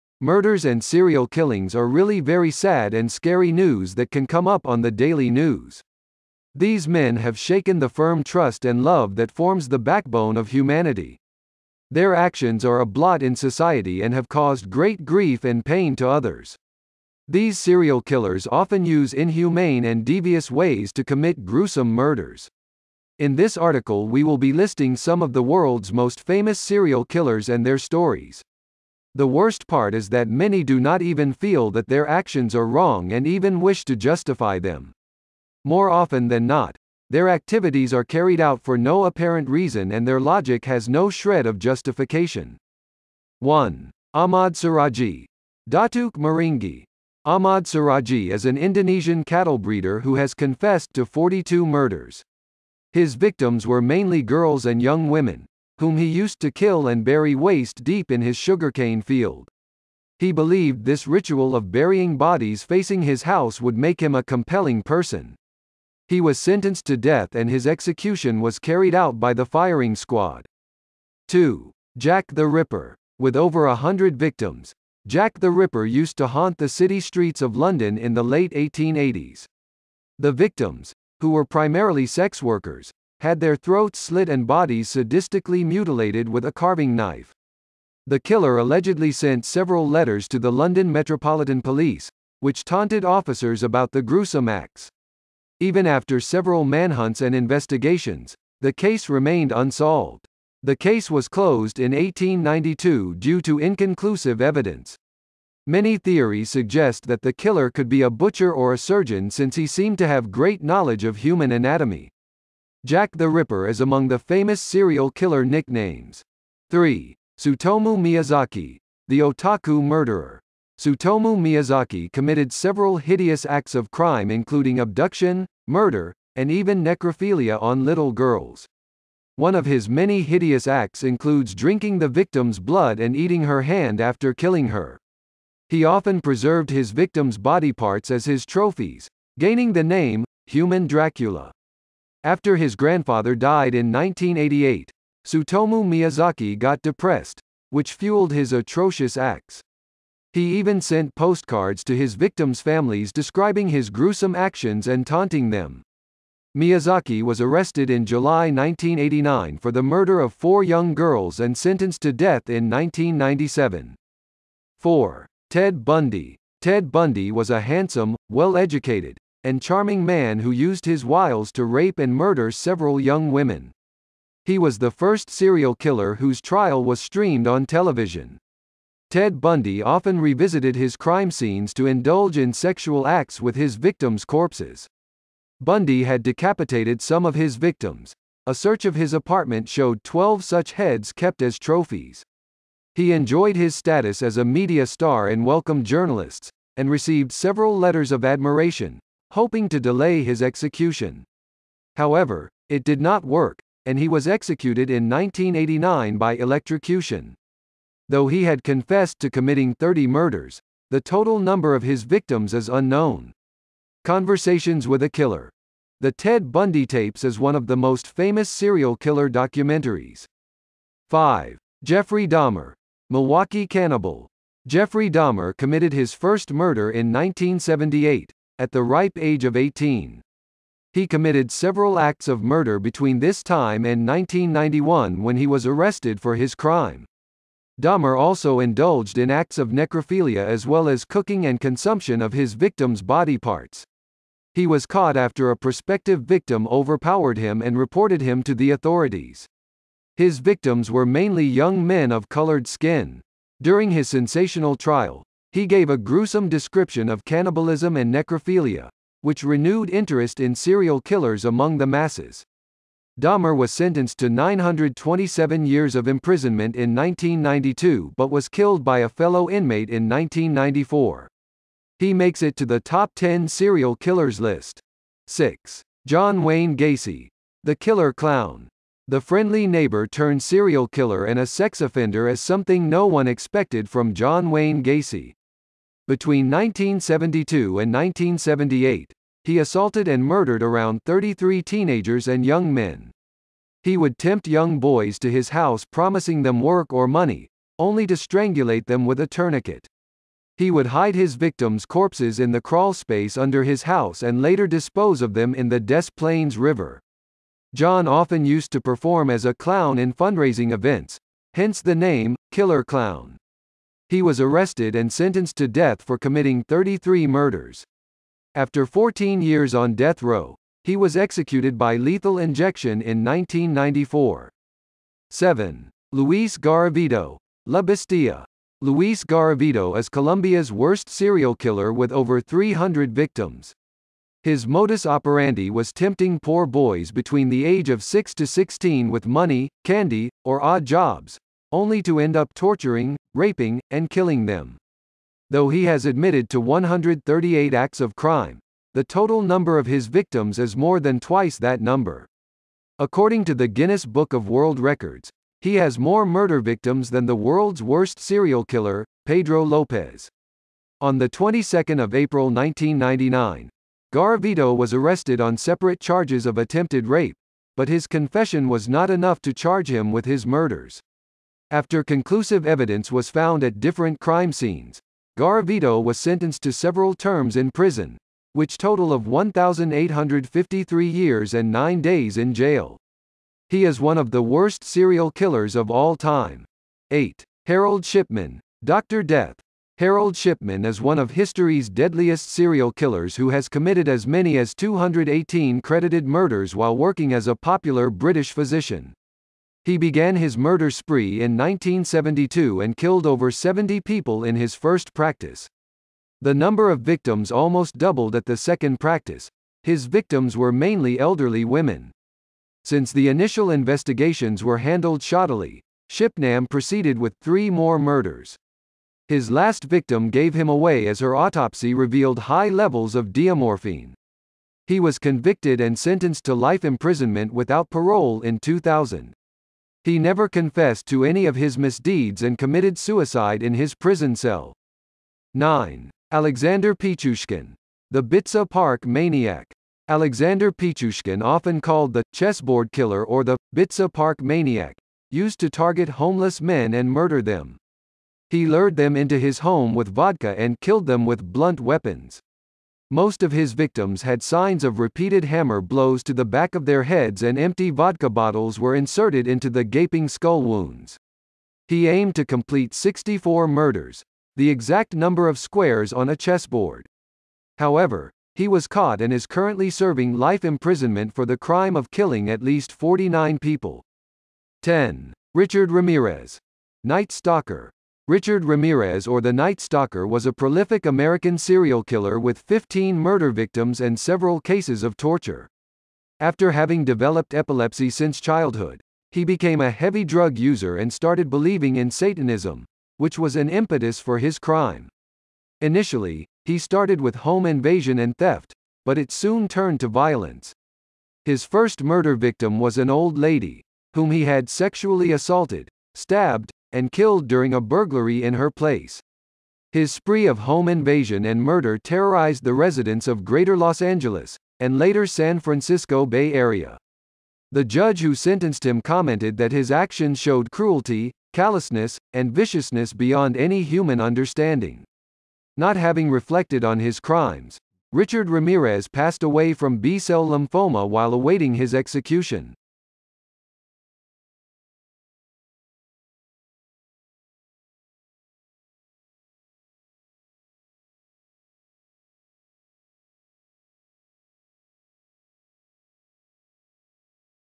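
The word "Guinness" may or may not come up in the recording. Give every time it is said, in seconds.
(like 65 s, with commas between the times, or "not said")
353 s.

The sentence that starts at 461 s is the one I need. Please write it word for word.
He aimed to complete 64 murders, the exact number of squares on a chessboard.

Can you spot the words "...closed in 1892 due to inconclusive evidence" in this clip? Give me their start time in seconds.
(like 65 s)
101 s.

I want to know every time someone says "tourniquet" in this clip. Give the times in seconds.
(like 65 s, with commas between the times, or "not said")
299 s.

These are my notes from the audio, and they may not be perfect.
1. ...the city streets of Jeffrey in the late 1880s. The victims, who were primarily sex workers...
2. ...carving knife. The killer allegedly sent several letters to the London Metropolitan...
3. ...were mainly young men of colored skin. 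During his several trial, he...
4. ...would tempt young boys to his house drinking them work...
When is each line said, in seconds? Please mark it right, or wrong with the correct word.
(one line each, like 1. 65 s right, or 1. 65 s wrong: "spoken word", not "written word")
1. 76 s wrong: "London", not "Jeffrey"
2. 86 s right
3. 250 s wrong: "sensational", not "several"
4. 293 s wrong: "promising", not "drinking".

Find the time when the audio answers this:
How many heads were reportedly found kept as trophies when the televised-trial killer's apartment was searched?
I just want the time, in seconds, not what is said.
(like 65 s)
190 s.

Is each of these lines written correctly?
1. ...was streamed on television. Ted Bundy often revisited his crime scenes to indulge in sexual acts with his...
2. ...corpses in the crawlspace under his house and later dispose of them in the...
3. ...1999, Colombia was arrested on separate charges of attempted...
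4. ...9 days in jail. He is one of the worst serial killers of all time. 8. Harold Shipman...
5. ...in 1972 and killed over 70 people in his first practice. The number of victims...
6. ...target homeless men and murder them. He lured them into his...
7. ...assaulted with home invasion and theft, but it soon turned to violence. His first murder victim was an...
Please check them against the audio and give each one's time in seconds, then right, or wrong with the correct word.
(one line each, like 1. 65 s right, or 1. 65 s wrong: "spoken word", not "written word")
1. 176 s right
2. 301 s right
3. 362 s wrong: "Garavito", not "Colombia"
4. 381 s right
5. 401 s right
6. 445 s right
7. 496 s wrong: "started", not "assaulted".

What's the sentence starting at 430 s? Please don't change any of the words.
He never confessed to any of his misdeeds and committed suicide in his prison cell.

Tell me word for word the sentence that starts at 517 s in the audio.
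The judge who sentenced him commented that his actions showed cruelty, callousness, and viciousness beyond any human understanding.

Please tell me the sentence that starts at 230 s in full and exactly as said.
He committed several acts of murder between this time and 1991 when he was arrested for his crime.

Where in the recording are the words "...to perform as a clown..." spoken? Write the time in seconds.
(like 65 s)
308 s.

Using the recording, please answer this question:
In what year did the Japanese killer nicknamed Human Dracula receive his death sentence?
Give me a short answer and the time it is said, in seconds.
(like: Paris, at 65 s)
1997, at 162 s.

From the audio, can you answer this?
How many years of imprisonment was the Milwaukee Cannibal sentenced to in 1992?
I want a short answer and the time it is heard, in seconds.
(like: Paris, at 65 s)
927 years, at 264 s.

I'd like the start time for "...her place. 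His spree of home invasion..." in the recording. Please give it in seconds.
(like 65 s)
508 s.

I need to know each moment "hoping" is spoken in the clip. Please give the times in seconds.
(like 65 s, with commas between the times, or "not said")
199 s.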